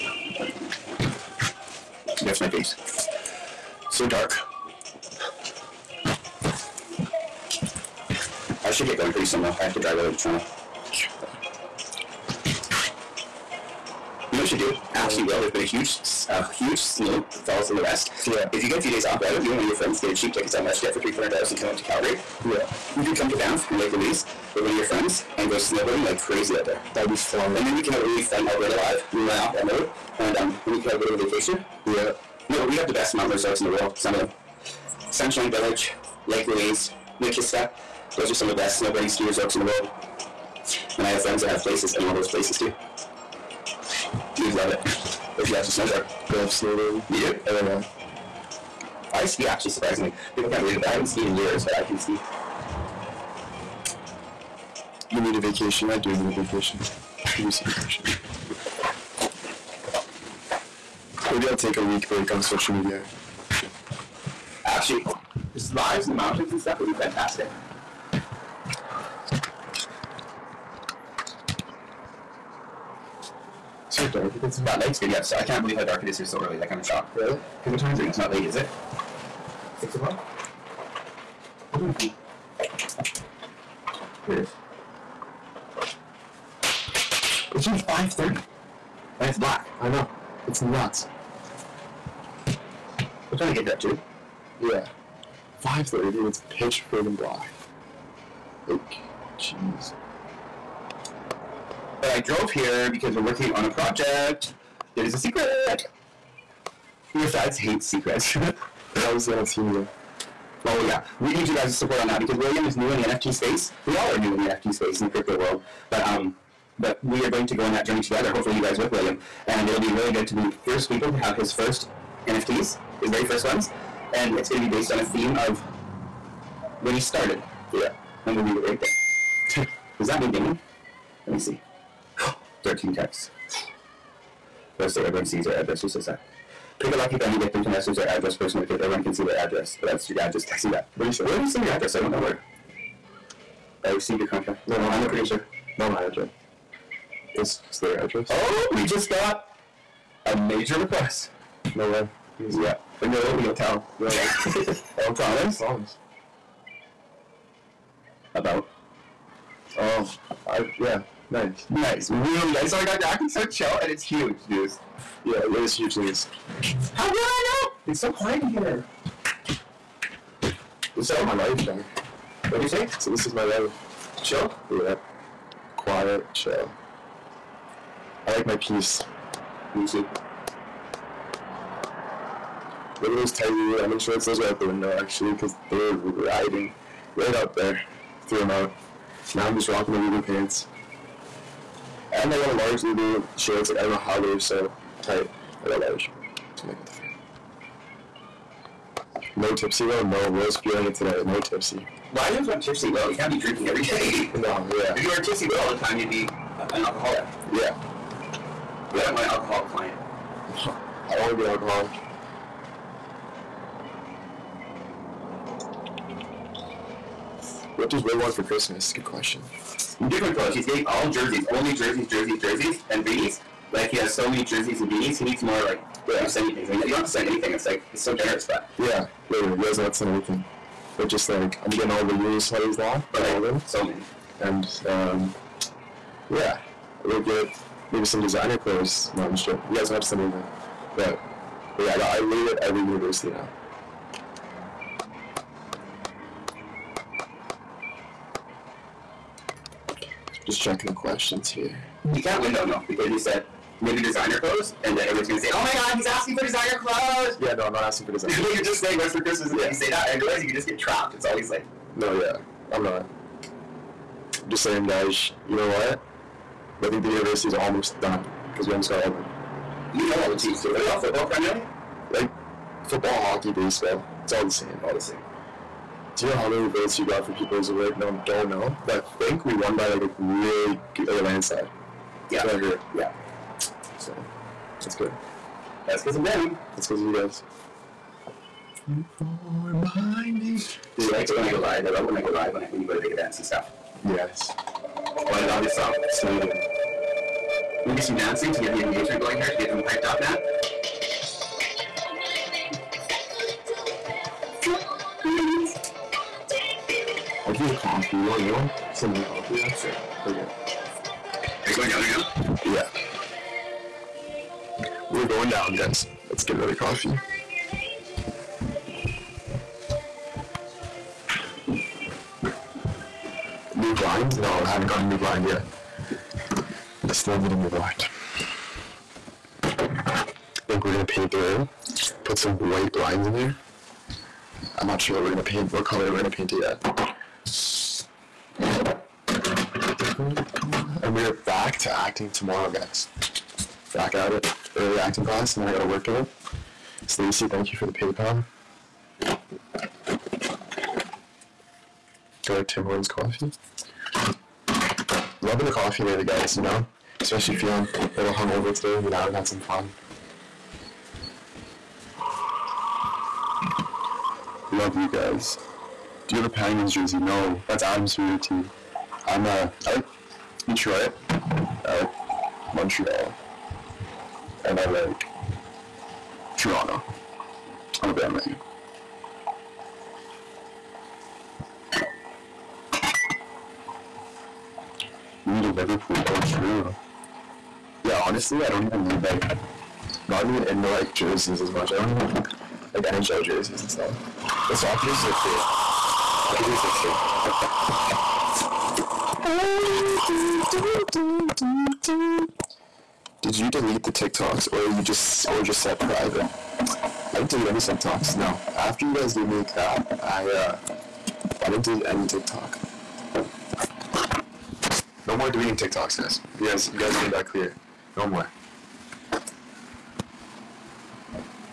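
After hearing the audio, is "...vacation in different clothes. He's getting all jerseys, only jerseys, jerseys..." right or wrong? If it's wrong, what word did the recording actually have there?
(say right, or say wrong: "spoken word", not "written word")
wrong: "question", not "vacation".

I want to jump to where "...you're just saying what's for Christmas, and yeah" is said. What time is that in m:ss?
4:18.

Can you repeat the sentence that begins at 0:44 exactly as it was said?
You'd love it if you like to snowboard.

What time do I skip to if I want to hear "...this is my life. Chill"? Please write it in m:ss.
2:53.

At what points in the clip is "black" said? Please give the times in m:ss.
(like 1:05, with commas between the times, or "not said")
1:29, 1:37.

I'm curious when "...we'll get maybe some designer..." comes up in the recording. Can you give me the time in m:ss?
3:57.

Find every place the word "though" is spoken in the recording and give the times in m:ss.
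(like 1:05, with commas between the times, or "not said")
0:09, 4:12.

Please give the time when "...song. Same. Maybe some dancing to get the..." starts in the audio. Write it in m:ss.
4:55.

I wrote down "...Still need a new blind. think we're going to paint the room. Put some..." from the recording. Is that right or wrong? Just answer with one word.
right.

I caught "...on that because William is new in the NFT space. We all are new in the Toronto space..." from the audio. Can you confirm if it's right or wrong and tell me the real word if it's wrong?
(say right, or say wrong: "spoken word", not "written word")
wrong: "NFT", not "Toronto".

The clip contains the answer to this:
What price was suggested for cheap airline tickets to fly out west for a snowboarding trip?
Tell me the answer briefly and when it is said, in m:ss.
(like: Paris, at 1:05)
$300, at 0:20.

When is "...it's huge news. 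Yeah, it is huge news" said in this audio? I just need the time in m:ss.
2:43.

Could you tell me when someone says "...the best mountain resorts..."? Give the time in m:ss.
0:32.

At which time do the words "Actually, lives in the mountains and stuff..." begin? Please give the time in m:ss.
1:04.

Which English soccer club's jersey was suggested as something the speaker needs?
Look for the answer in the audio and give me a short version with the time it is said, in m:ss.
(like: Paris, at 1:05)
Liverpool, at 6:25.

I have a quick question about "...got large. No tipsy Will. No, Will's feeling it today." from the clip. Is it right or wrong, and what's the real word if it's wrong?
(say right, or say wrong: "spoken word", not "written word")
right.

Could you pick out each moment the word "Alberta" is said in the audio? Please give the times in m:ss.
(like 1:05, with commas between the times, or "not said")
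0:28.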